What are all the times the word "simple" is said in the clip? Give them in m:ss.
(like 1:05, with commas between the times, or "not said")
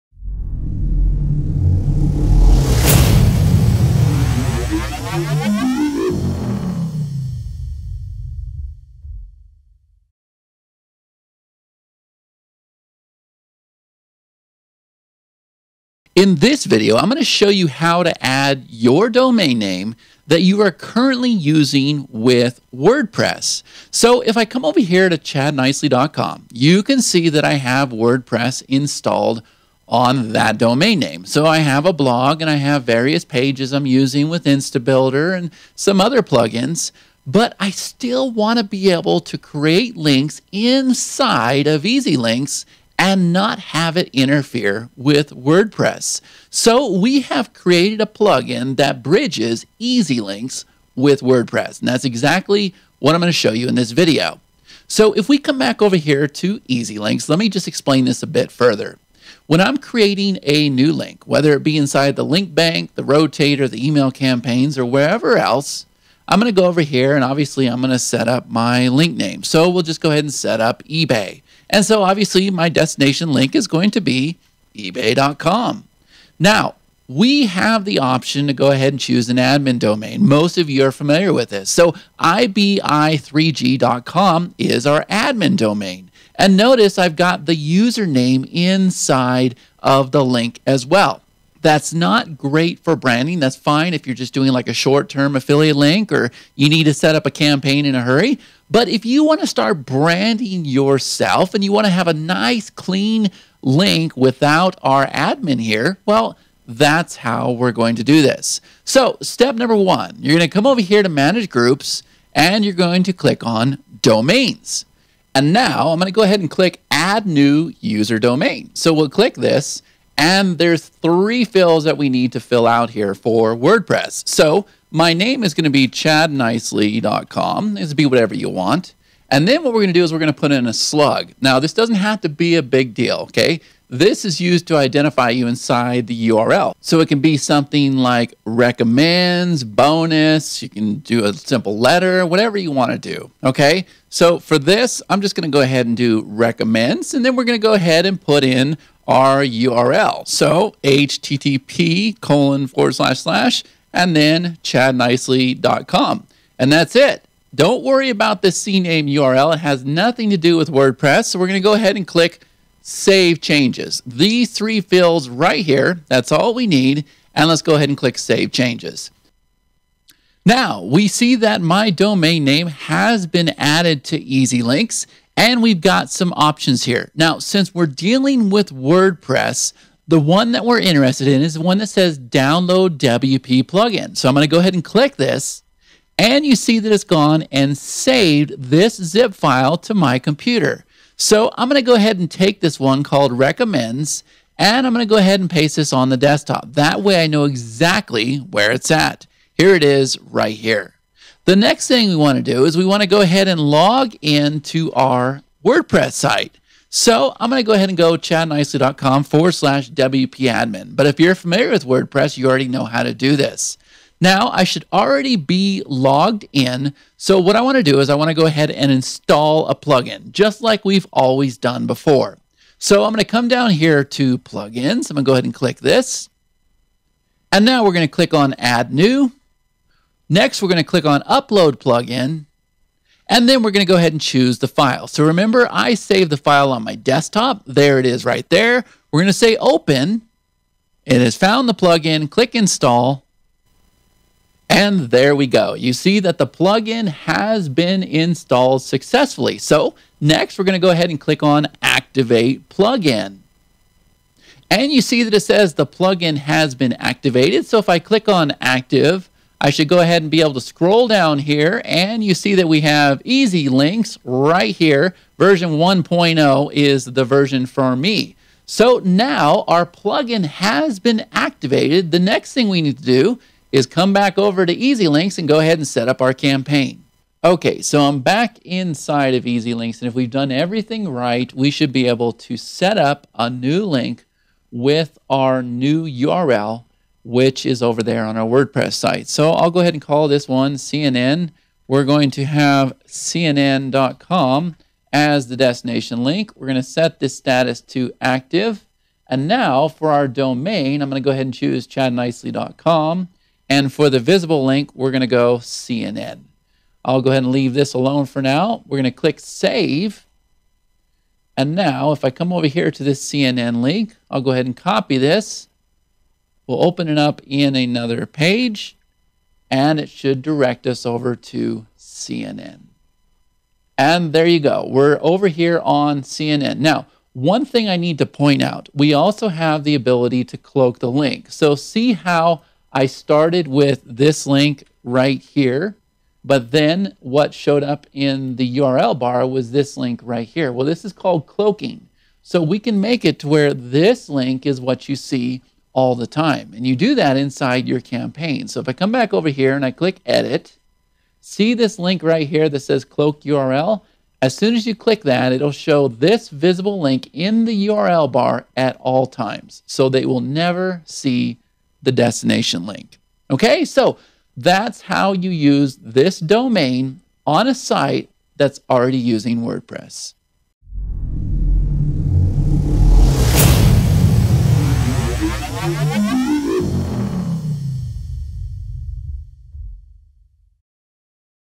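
2:21.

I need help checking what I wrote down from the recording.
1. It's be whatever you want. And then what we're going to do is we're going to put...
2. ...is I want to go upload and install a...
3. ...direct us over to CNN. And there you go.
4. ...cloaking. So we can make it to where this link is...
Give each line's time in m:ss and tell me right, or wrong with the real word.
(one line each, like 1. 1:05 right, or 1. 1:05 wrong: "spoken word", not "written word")
1. 2:07 right
2. 3:37 wrong: "ahead", not "upload"
3. 5:20 right
4. 5:41 right.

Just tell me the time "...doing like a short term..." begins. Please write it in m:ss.
1:34.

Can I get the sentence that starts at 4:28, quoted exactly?
So now our plugin has been activated.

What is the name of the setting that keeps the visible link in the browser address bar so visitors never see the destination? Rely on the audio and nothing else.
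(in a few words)
cloak URL.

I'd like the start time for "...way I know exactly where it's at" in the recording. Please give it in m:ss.
3:17.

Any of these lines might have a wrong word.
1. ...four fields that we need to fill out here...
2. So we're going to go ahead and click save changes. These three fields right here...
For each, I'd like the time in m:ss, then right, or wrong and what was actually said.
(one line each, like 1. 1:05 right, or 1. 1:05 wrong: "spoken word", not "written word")
1. 2:00 wrong: "three", not "four"
2. 2:41 right.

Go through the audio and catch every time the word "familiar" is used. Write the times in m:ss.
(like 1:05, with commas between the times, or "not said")
1:20, 3:31.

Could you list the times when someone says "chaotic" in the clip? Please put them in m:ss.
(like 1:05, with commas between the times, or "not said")
not said.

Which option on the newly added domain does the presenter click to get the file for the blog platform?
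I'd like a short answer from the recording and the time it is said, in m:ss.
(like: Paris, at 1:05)
download WP plugin, at 3:02.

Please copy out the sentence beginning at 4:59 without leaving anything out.
And now for our domain, I'm going to go ahead and choose chadnicely.com.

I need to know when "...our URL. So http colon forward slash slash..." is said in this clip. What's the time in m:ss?
2:29.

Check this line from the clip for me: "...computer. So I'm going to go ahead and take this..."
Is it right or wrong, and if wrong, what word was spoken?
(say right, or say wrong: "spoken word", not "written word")
right.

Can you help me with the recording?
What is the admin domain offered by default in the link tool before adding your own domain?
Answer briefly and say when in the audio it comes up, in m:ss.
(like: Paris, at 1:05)
ibi3g.com, at 1:22.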